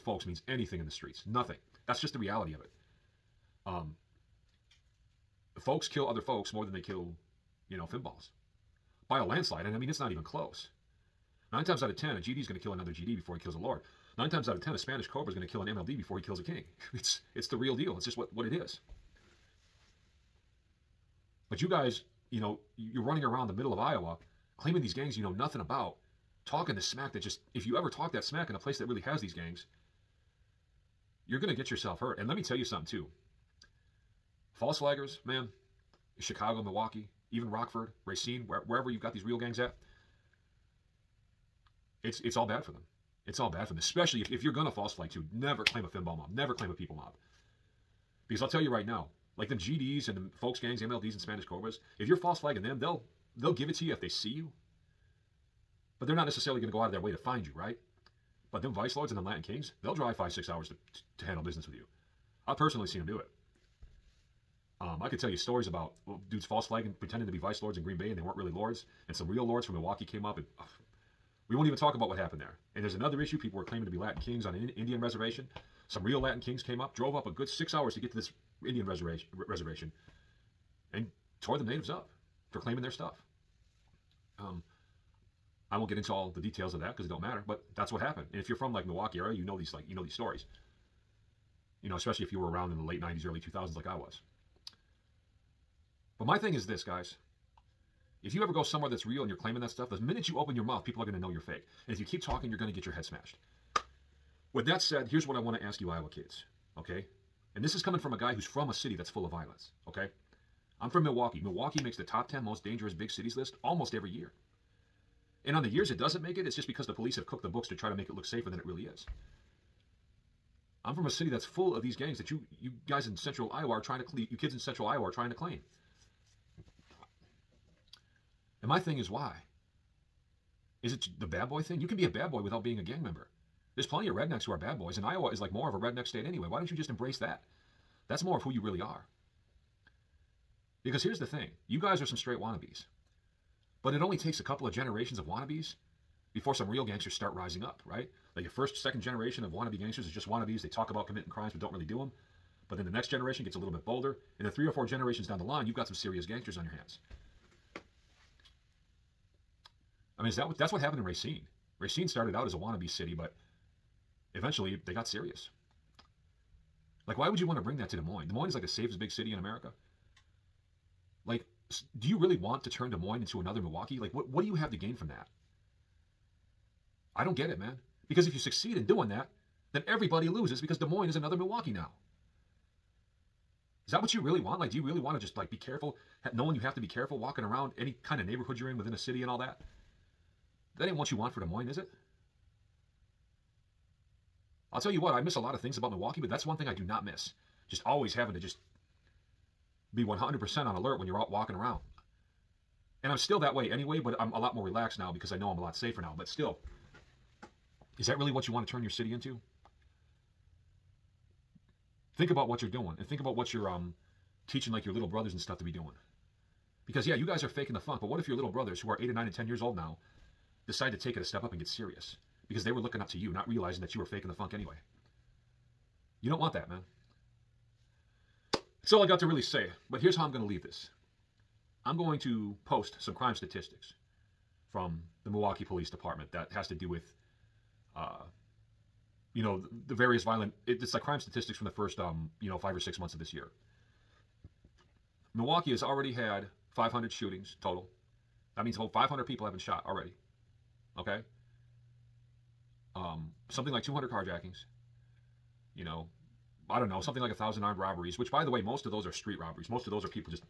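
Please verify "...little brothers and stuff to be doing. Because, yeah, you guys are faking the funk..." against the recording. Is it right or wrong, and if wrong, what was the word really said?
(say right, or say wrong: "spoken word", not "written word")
right.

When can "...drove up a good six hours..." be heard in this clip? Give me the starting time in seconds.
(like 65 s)
76 s.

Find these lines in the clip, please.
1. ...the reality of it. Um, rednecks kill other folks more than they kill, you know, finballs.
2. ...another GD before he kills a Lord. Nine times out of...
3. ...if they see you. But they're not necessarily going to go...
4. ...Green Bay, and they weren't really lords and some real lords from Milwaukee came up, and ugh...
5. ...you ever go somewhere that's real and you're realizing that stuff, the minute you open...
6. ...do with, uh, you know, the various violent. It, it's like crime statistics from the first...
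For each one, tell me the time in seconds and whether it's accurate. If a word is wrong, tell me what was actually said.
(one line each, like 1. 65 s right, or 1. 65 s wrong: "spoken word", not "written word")
1. 2 s wrong: "folks", not "rednecks"
2. 12 s right
3. 53 s right
4. 67 s right
5. 98 s wrong: "claiming", not "realizing"
6. 236 s right.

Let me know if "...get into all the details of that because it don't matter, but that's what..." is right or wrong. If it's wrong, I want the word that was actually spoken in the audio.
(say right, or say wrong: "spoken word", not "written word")
right.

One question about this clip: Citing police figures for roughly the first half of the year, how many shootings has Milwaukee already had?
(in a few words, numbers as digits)
500.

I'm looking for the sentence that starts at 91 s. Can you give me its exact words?
You know, especially if you were around in the late 90s, early 2000s like I was.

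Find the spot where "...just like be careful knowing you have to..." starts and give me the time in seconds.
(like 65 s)
185 s.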